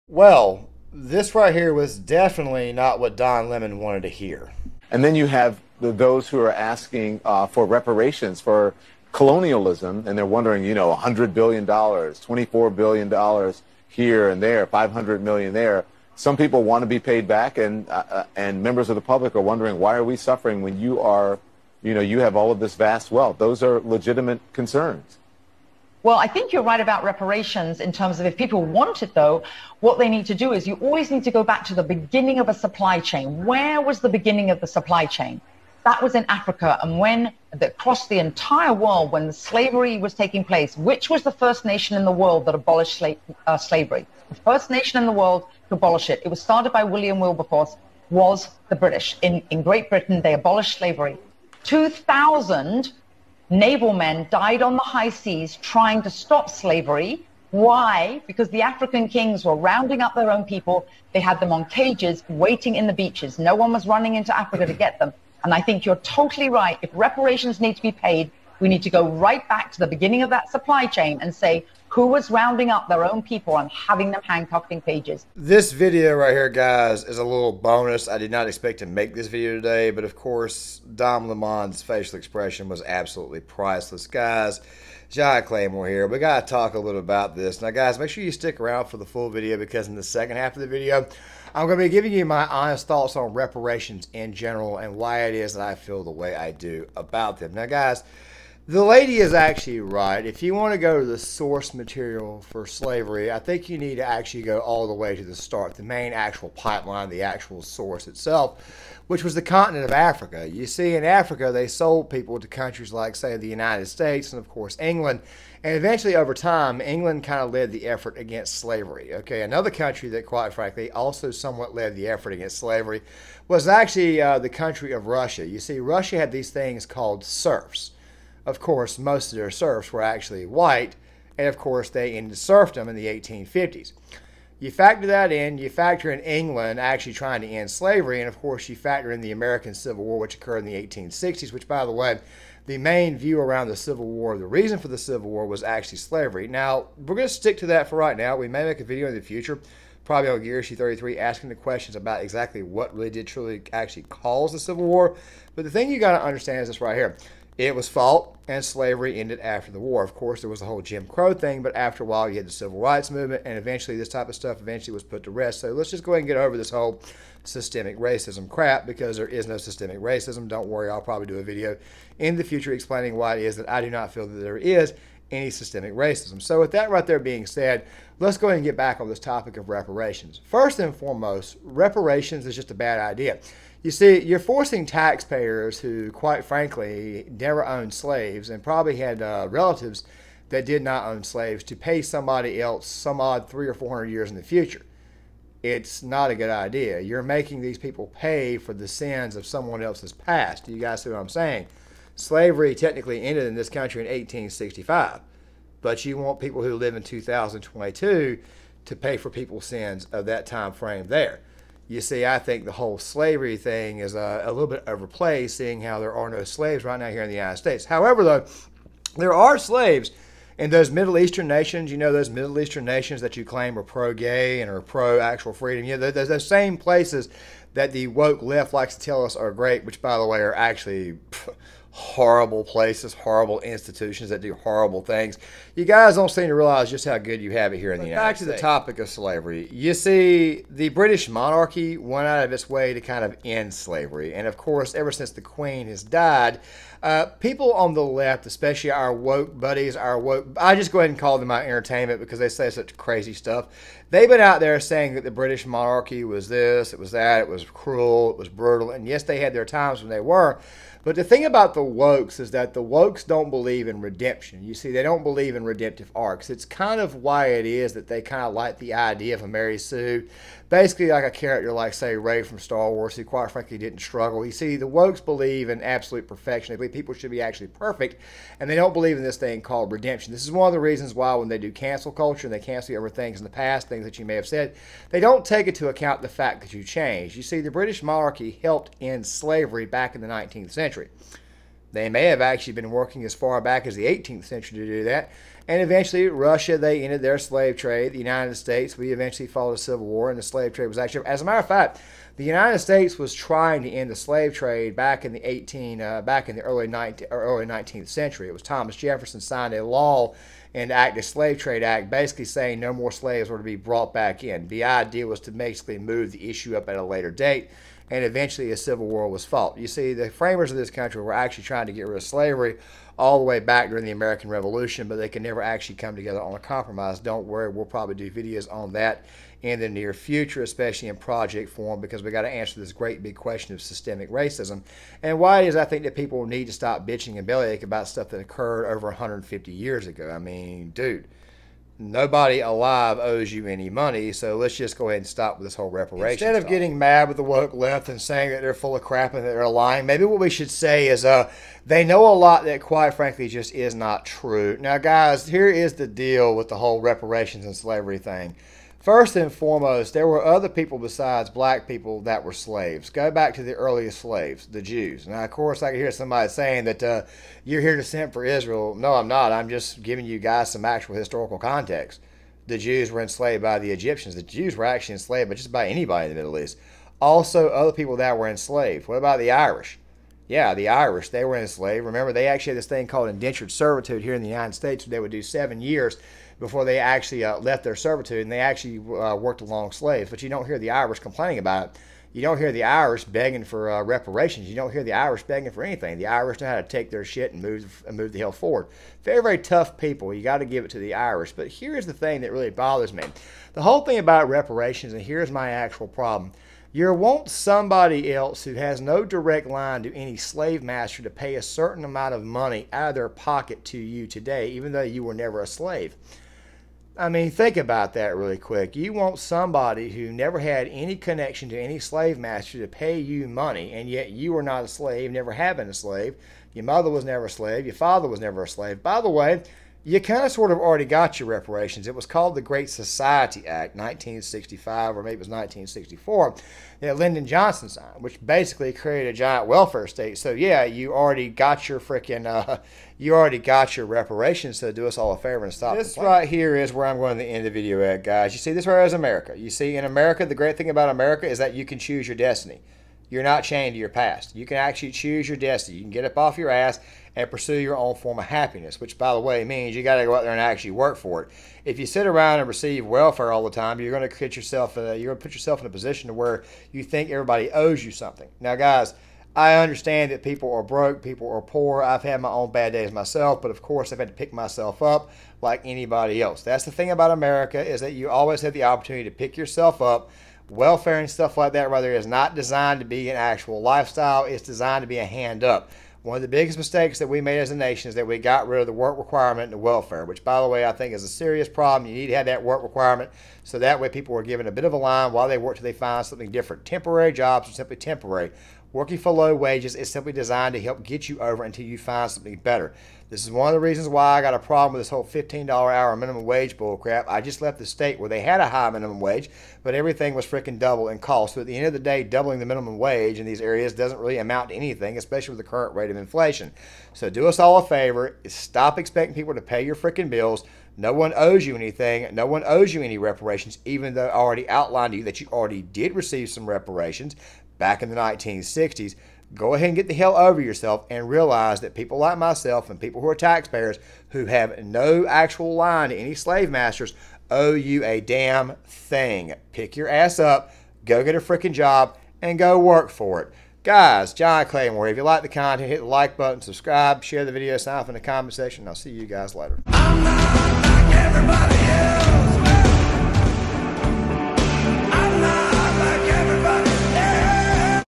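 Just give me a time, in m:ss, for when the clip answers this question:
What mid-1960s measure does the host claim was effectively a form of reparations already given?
7:12.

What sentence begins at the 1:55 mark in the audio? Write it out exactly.
And eventually, over time, England kind of led the effort against slavery.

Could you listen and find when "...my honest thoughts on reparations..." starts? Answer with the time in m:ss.
1:32.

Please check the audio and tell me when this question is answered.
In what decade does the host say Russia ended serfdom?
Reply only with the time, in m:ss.
2:13.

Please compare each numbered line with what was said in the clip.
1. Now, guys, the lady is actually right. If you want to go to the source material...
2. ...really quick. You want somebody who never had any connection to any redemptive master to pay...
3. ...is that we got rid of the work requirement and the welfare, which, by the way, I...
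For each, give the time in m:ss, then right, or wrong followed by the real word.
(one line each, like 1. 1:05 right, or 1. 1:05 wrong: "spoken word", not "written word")
1. 1:37 right
2. 6:58 wrong: "slave", not "redemptive"
3. 8:08 right.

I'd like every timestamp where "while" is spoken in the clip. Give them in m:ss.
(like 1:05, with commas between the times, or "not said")
2:42, 8:15.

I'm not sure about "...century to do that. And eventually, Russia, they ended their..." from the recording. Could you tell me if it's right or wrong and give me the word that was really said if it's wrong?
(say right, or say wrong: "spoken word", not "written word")
right.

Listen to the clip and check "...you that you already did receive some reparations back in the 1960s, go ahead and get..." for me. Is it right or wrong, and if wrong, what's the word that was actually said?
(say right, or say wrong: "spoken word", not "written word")
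right.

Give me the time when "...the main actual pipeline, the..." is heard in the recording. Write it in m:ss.
1:45.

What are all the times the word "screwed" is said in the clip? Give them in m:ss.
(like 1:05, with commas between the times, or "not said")
not said.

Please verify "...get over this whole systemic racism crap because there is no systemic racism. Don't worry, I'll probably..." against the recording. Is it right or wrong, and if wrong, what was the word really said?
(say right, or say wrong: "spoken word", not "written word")
right.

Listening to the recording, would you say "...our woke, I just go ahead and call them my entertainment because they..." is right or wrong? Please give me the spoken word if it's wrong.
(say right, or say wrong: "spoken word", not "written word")
right.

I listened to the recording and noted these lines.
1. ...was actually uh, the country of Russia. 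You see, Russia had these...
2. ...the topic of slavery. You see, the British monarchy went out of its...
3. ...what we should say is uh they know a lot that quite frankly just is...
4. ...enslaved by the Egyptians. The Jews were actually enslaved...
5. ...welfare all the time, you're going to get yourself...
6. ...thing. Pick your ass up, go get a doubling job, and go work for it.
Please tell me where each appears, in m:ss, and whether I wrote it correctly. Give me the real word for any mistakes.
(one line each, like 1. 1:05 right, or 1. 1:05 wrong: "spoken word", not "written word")
1. 2:03 right
2. 3:58 right
3. 5:50 right
4. 6:13 right
5. 7:43 right
6. 8:58 wrong: "freaking", not "doubling".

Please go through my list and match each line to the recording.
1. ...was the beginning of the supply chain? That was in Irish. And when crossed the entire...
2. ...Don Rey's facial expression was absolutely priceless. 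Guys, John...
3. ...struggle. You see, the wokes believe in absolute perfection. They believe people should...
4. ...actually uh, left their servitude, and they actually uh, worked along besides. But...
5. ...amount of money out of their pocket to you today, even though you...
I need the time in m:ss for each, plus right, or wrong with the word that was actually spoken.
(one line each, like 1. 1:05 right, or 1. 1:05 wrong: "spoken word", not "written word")
1. 0:33 wrong: "Africa", not "Irish"
2. 1:20 wrong: "Lemon", not "Rey"
3. 4:33 right
4. 6:26 wrong: "slaves", not "besides"
5. 6:52 right.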